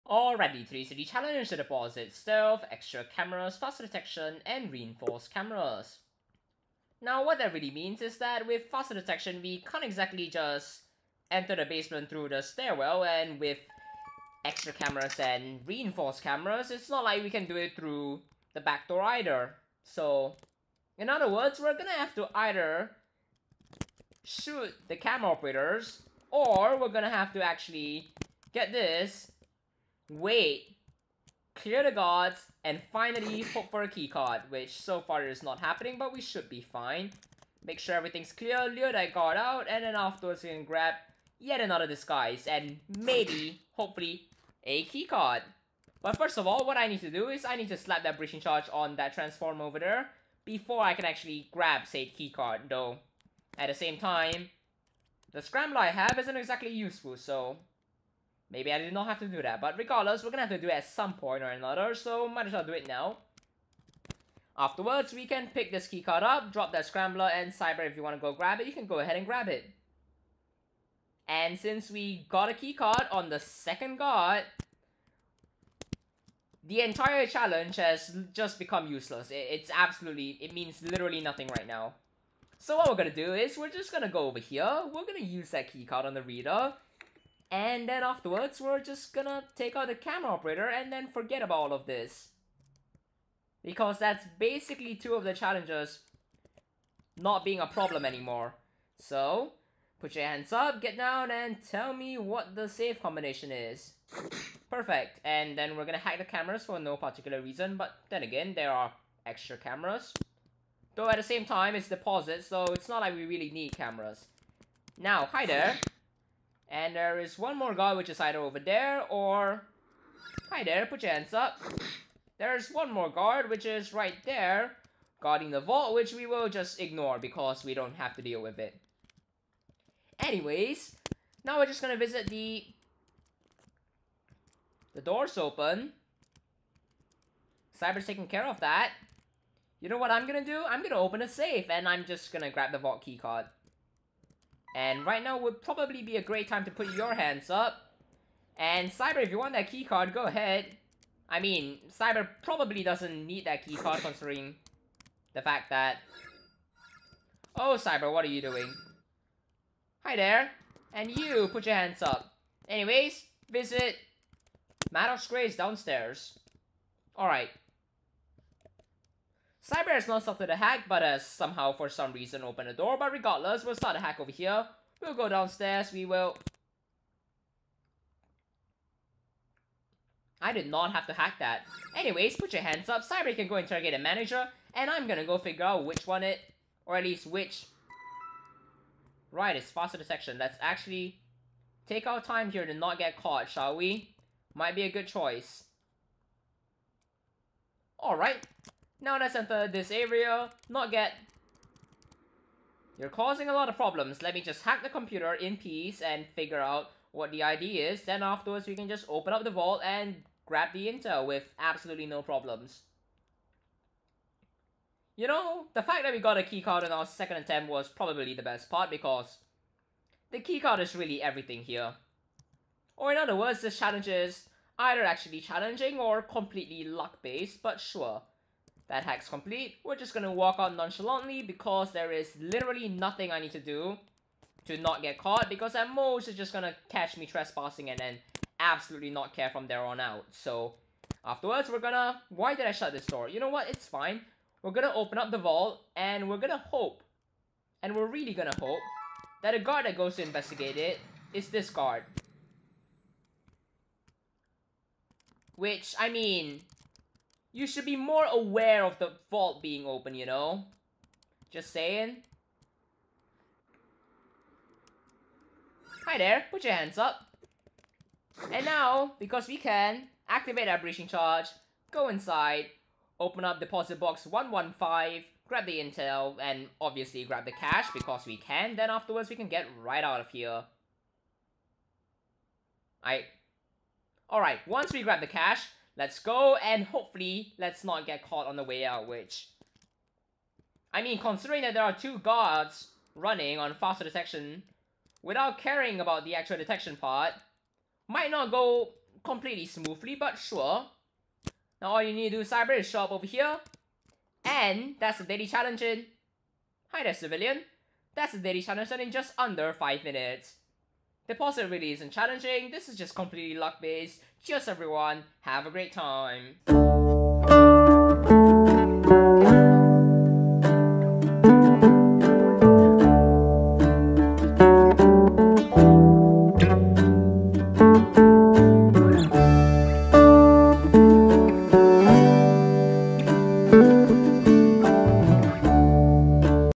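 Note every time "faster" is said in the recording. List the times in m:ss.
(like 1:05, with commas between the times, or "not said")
0:03, 0:08, 3:09, 4:53.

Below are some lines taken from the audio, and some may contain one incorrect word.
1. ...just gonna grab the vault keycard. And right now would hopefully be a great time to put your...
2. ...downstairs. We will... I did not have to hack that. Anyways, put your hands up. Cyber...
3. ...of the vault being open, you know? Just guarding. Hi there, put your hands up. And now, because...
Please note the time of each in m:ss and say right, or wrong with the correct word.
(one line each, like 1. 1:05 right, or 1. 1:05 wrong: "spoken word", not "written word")
1. 2:22 wrong: "probably", not "hopefully"
2. 2:55 right
3. 4:18 wrong: "saying", not "guarding".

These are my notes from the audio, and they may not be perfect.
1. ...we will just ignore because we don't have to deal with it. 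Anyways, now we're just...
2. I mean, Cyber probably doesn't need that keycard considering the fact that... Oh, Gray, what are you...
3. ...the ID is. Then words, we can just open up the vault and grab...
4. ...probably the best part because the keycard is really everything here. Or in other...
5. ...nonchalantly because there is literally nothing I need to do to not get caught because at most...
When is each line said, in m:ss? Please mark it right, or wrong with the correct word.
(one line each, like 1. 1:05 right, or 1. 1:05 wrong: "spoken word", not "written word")
1. 2:06 right
2. 2:31 wrong: "Cyber", not "Gray"
3. 3:27 wrong: "afterwards", not "words"
4. 3:37 right
5. 3:50 right.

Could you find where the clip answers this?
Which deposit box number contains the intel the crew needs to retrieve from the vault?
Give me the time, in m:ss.
4:34.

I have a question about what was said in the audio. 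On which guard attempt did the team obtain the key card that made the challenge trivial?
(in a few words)
Second guard.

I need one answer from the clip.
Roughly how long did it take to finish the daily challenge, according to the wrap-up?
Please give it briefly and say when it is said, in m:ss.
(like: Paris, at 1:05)
Just under 5 minutes, at 5:09.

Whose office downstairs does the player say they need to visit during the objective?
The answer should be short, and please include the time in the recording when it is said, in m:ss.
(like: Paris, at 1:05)
Maddox Gray, at 2:44.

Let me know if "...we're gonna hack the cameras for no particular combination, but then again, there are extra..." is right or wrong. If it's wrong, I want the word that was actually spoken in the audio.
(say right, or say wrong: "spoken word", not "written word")
wrong: "reason", not "combination".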